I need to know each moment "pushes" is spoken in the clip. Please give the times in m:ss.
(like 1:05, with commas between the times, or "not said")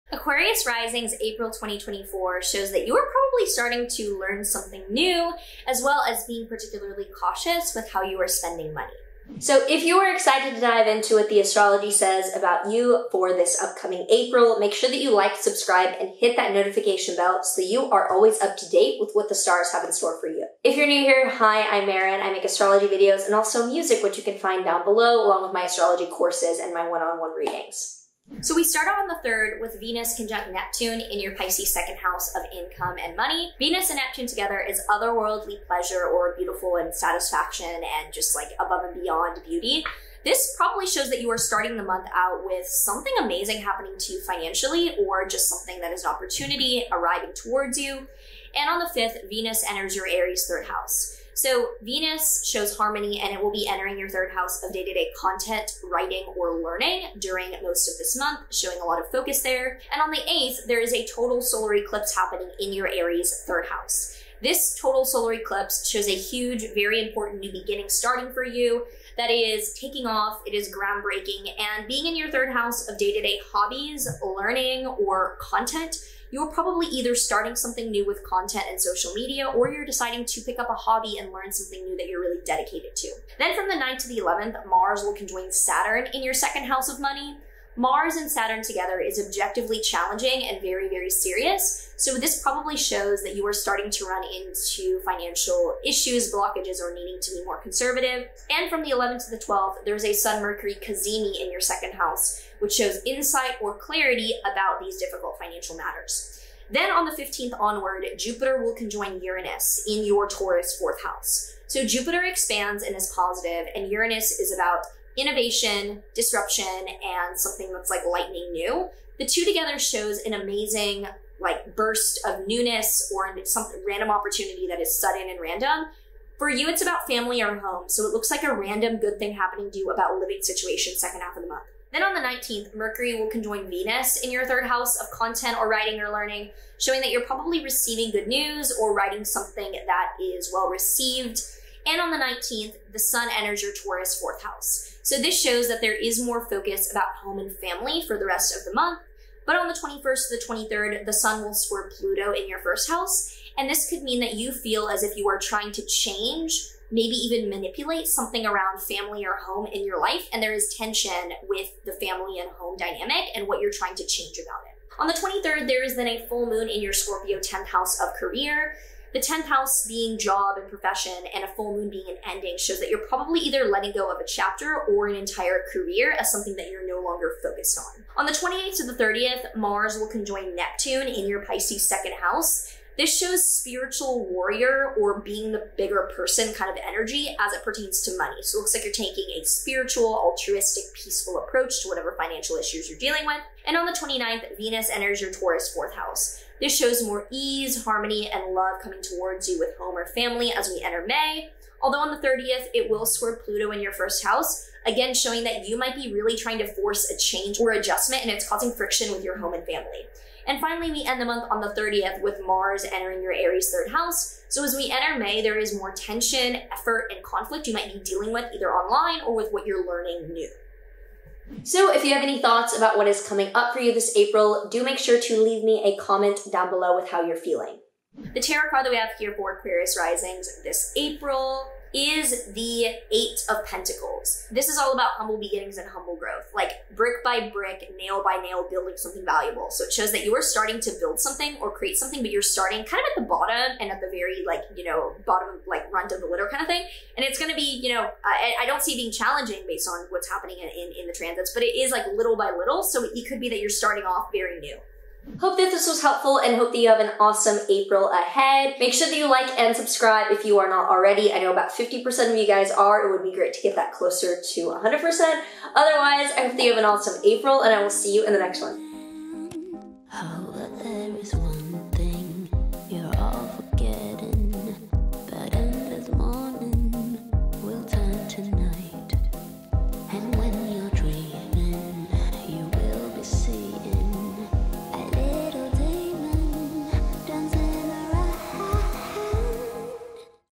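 not said.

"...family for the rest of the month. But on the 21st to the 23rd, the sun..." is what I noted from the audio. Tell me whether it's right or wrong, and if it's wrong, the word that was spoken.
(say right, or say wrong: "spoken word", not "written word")
right.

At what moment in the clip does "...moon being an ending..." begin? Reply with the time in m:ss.
2:51.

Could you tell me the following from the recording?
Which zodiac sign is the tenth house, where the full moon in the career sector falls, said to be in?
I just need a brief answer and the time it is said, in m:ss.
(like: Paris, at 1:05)
Scorpio, at 2:46.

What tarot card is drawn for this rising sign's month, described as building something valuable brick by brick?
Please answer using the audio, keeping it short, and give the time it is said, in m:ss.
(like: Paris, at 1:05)
Eight of Pentacles, at 3:53.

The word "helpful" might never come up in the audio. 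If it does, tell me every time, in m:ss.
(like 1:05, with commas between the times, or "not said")
4:16.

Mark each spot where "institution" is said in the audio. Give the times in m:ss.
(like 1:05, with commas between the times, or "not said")
not said.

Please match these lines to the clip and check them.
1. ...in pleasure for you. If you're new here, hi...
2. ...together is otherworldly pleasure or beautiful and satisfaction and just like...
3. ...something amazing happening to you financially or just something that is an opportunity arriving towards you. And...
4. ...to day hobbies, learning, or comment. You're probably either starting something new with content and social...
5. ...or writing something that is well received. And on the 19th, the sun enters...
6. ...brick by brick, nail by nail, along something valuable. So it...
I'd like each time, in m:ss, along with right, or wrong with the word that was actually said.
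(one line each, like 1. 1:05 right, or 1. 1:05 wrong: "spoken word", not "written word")
1. 0:19 wrong: "store", not "pleasure"
2. 0:34 right
3. 0:42 right
4. 1:13 wrong: "content", not "comment"
5. 2:18 right
6. 3:56 wrong: "building", not "along".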